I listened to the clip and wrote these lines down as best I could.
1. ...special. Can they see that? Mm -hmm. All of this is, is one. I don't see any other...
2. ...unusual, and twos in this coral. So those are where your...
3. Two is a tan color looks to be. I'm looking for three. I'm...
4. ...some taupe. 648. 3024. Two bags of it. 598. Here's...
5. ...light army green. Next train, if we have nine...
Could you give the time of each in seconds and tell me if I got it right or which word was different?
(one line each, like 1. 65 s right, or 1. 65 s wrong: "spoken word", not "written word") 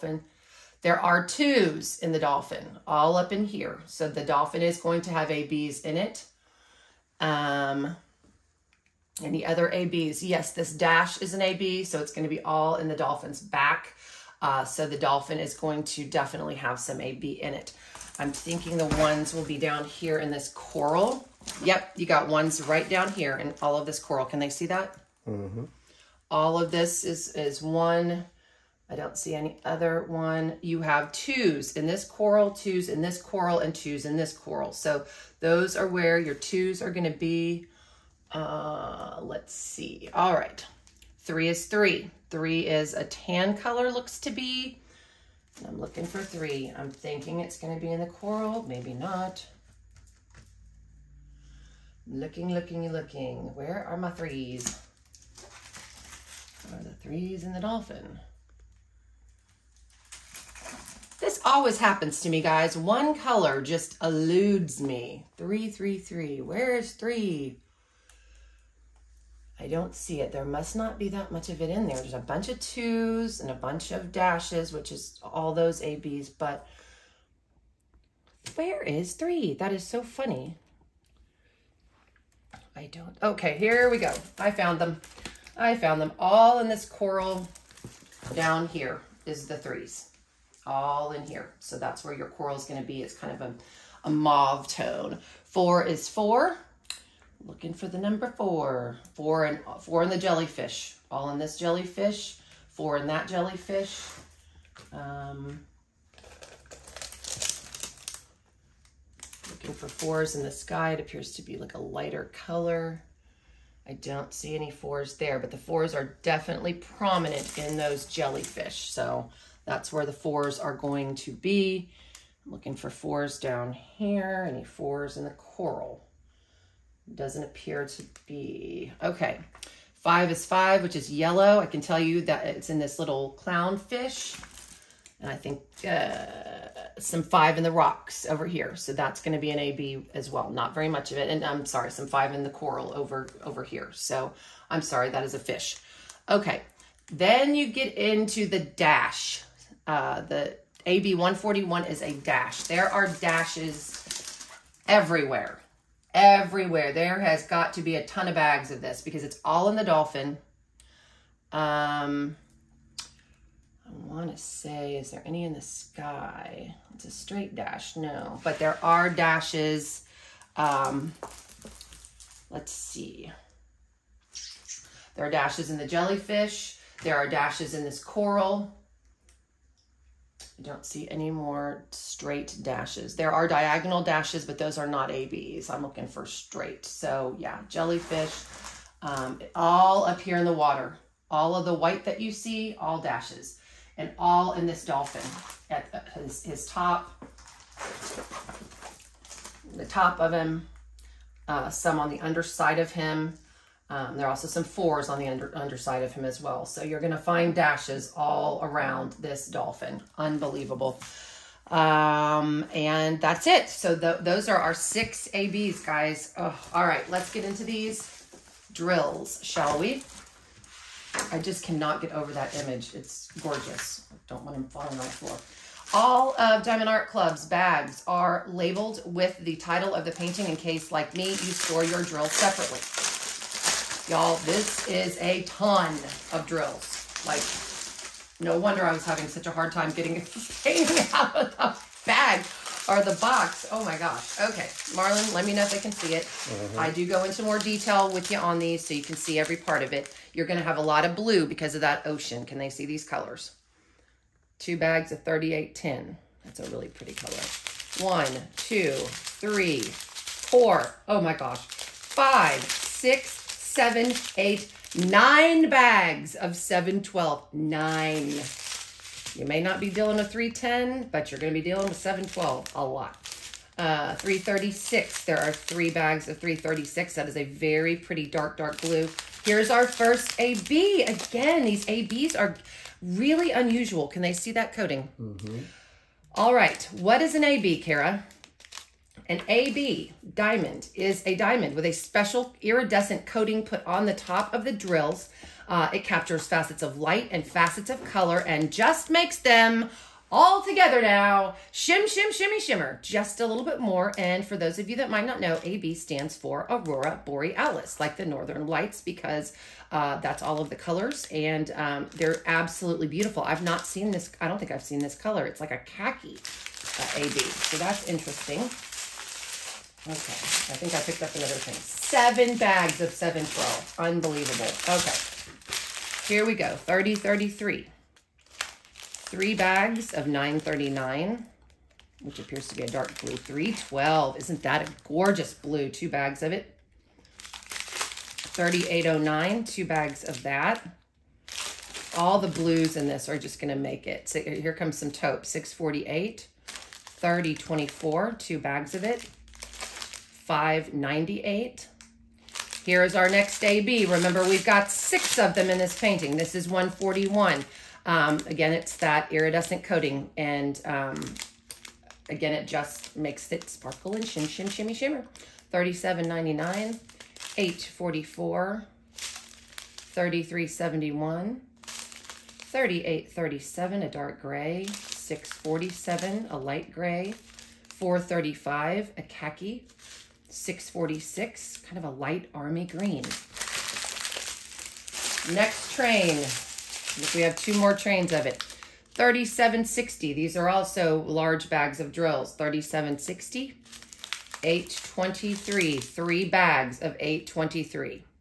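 1. 23 s wrong: "coral", not "special"
2. 33 s wrong: "coral", not "unusual"
3. 42 s wrong: "Three", not "Two"
4. 344 s right
5. 382 s wrong: "two", not "nine".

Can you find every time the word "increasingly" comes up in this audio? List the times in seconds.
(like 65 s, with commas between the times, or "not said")
not said.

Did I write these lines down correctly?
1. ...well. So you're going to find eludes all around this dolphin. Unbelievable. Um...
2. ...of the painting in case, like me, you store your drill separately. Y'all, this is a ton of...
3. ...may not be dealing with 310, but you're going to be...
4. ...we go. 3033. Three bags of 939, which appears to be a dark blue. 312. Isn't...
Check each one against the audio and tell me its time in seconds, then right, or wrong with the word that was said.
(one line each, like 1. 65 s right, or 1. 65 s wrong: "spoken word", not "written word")
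1. 206 s wrong: "dashes", not "eludes"
2. 229 s right
3. 269 s right
4. 326 s right.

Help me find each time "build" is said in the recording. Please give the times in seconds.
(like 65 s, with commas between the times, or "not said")
not said.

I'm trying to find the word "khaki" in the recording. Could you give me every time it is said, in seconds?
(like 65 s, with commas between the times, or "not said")
315 s, 379 s.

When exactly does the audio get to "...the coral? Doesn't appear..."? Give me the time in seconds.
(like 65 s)
125 s.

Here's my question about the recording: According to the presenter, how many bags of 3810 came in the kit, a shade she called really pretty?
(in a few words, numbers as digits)
2.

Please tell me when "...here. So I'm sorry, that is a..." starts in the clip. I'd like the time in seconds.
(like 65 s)
143 s.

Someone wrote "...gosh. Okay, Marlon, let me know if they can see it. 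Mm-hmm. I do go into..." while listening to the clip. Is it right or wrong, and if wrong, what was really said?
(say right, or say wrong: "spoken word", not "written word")
right.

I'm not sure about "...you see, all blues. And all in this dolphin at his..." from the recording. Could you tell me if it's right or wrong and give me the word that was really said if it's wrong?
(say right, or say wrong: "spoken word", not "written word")
wrong: "dashes", not "blues".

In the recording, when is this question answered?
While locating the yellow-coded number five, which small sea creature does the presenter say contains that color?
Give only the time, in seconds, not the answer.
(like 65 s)
133 s.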